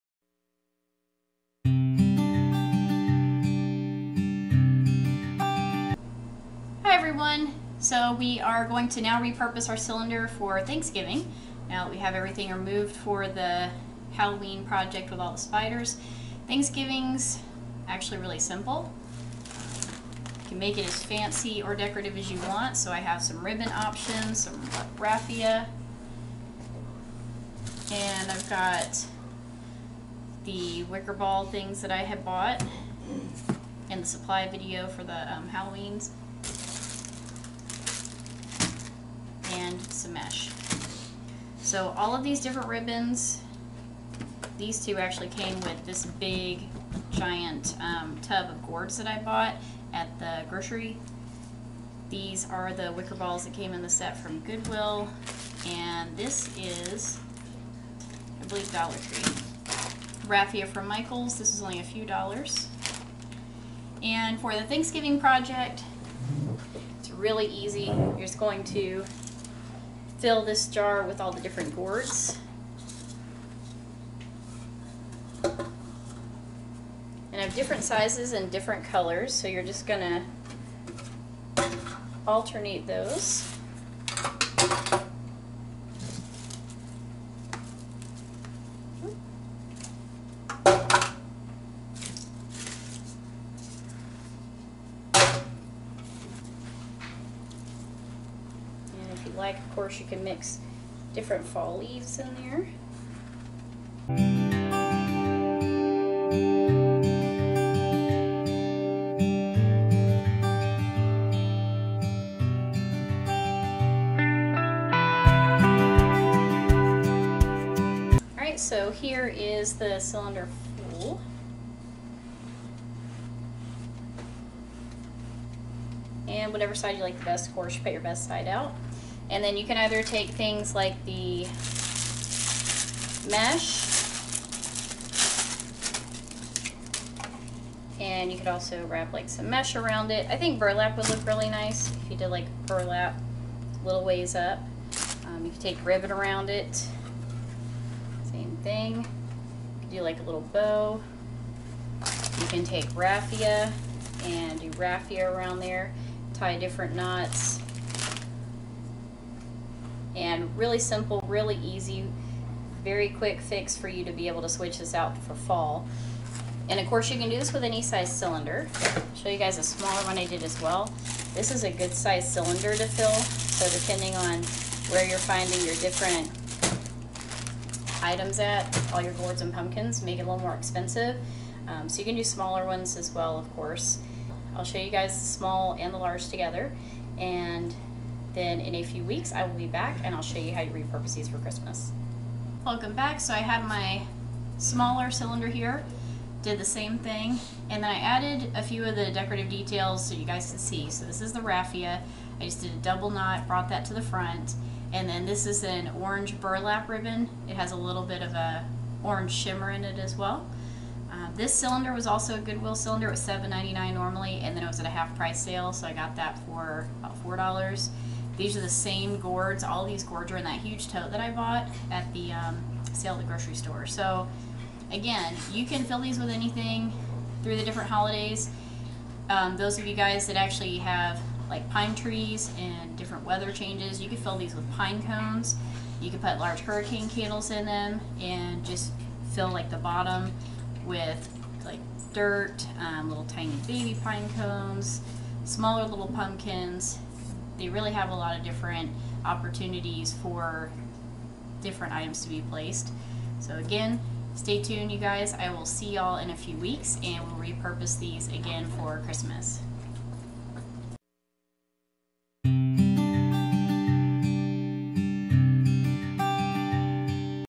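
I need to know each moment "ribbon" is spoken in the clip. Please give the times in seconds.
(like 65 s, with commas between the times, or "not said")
23 s, 42 s, 145 s, 206 s.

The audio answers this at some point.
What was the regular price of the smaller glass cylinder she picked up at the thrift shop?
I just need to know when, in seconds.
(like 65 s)
213 s.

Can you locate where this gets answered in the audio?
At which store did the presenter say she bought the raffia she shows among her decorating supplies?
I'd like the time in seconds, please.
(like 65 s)
60 s.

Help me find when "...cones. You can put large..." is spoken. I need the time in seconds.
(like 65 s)
235 s.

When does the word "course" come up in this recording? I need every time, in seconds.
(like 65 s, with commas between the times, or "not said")
99 s, 127 s, 166 s, 183 s.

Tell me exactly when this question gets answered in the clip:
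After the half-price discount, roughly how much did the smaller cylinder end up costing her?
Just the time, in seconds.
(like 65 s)
217 s.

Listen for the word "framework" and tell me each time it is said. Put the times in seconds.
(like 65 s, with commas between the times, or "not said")
not said.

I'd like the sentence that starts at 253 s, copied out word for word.
So again, stay tuned you guys.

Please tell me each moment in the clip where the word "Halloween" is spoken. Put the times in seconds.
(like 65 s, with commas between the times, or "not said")
14 s, 35 s.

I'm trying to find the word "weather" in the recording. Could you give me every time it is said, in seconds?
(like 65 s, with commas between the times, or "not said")
233 s.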